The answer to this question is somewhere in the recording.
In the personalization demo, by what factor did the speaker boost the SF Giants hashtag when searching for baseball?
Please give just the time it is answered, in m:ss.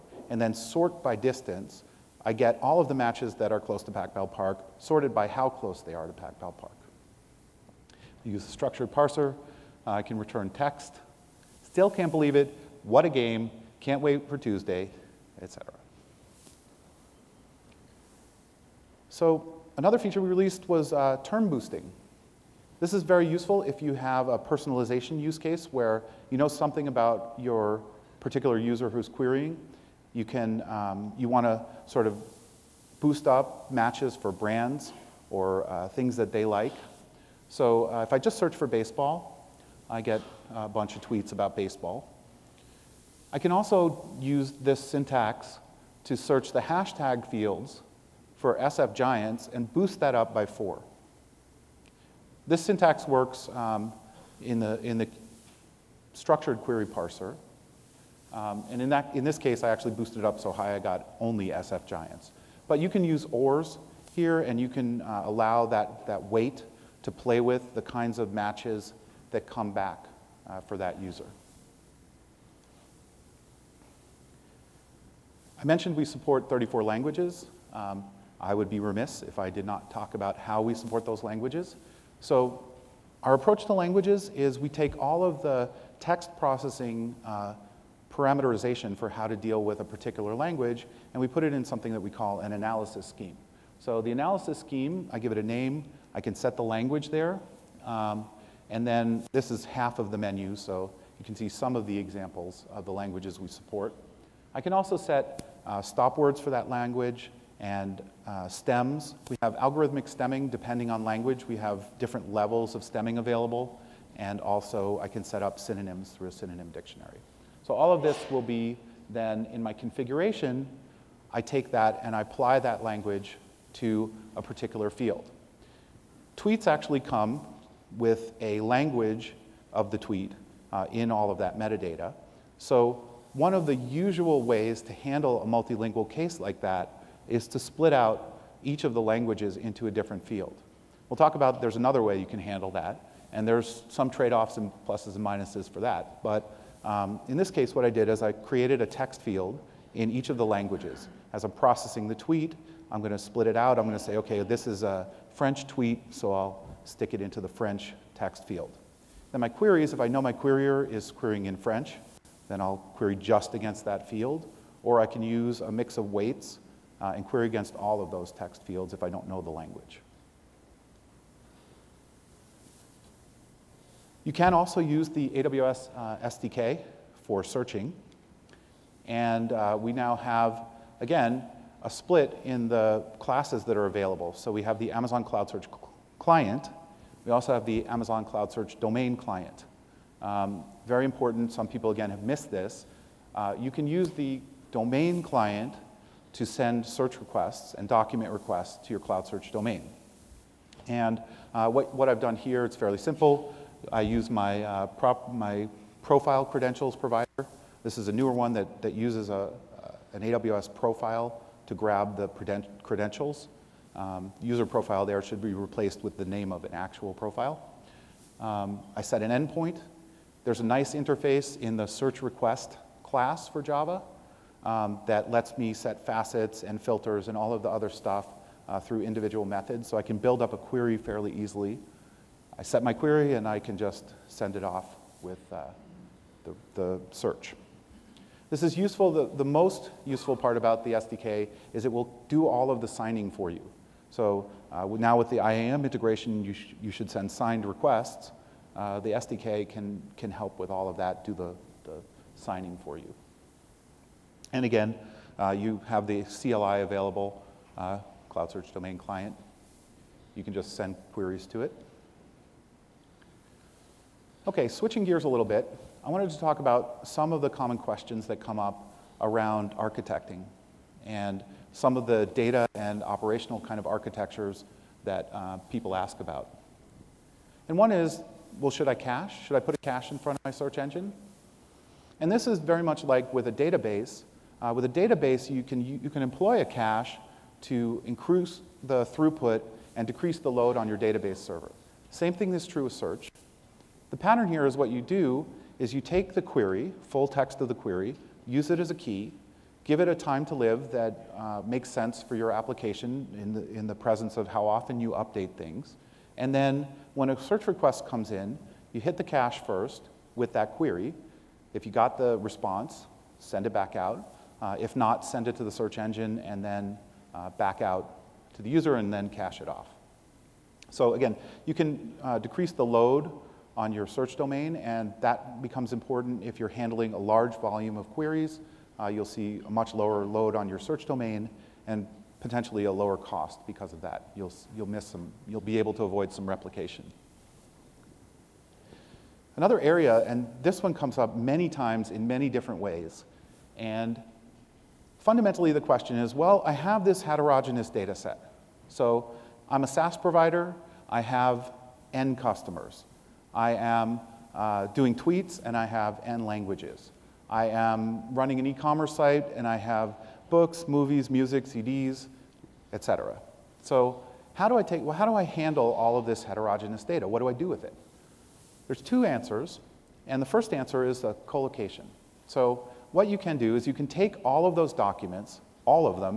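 0:50.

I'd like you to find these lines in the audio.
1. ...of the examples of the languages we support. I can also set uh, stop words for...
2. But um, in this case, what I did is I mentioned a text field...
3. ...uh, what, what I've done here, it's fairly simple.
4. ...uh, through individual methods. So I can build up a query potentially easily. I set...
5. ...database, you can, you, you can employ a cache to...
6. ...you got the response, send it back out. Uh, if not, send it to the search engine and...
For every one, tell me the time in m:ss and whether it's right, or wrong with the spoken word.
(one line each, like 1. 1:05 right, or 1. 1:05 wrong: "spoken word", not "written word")
1. 1:41 right
2. 2:26 wrong: "created", not "mentioned"
3. 3:21 right
4. 3:48 wrong: "fairly", not "potentially"
5. 4:44 right
6. 5:11 right.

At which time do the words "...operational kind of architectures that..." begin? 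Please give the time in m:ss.
4:33.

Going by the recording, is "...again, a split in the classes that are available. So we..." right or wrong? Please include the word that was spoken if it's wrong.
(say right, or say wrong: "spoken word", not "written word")
right.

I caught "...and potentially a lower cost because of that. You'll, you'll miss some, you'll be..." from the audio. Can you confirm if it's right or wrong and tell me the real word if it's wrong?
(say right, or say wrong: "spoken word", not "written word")
right.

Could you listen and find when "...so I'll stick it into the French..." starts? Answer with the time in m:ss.
2:36.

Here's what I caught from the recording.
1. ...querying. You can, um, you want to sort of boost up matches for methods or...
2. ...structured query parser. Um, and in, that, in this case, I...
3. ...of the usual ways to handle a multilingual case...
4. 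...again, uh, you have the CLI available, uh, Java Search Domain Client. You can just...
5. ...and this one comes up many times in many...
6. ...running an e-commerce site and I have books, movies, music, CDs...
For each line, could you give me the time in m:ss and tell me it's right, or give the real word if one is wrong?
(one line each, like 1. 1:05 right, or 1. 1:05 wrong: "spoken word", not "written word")
1. 0:29 wrong: "brands", not "methods"
2. 0:56 right
3. 2:13 right
4. 4:14 wrong: "Cloud", not "Java"
5. 5:40 right
6. 5:58 right.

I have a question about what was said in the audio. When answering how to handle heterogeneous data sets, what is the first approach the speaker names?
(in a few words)
collocation.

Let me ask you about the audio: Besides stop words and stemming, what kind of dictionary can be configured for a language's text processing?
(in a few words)
synonym dictionary.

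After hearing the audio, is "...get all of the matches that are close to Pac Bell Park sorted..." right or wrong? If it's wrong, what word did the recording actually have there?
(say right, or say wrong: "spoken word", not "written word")
right.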